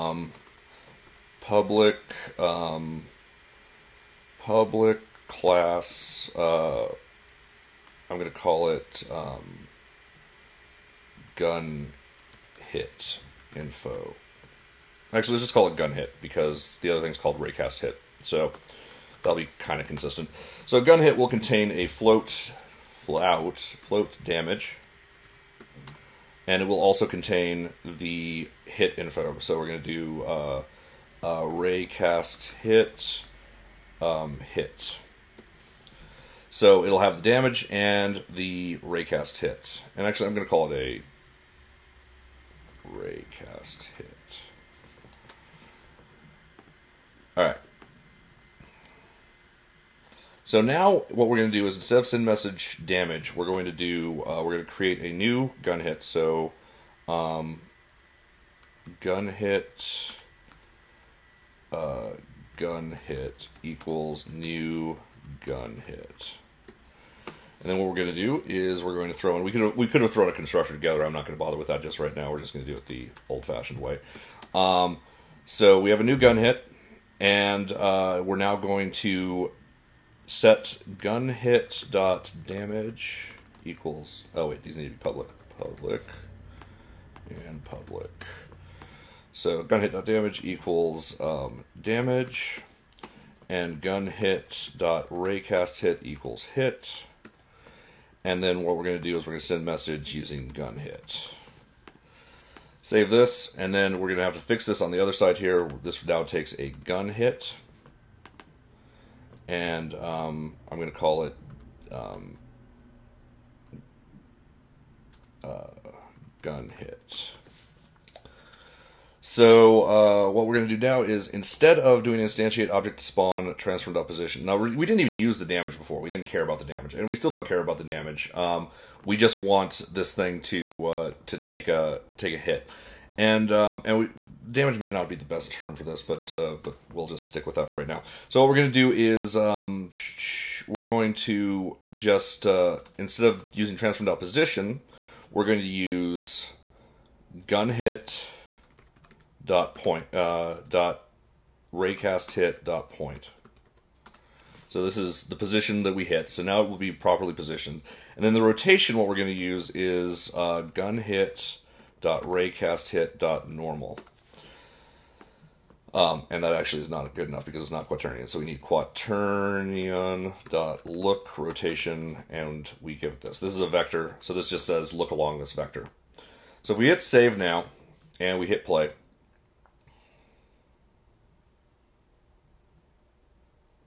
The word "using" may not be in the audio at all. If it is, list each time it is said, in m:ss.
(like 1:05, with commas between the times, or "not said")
1:40, 2:23.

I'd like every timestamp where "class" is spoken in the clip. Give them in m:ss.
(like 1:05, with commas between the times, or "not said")
0:05.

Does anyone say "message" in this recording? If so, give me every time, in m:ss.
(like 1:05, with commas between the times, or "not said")
0:52, 1:39.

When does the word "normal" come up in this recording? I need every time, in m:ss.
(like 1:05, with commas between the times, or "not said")
2:43.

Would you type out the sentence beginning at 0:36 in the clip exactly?
So it'll have the damage and the raycast hit.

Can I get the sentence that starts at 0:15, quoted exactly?
Actually, let's just call it gun hit because the other thing's called raycast hit.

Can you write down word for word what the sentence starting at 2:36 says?
So now it will be properly positioned.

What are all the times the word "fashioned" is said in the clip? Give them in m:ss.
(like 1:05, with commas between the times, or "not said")
1:13.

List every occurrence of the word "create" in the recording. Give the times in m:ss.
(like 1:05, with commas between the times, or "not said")
0:54.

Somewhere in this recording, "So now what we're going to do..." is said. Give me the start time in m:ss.
0:50.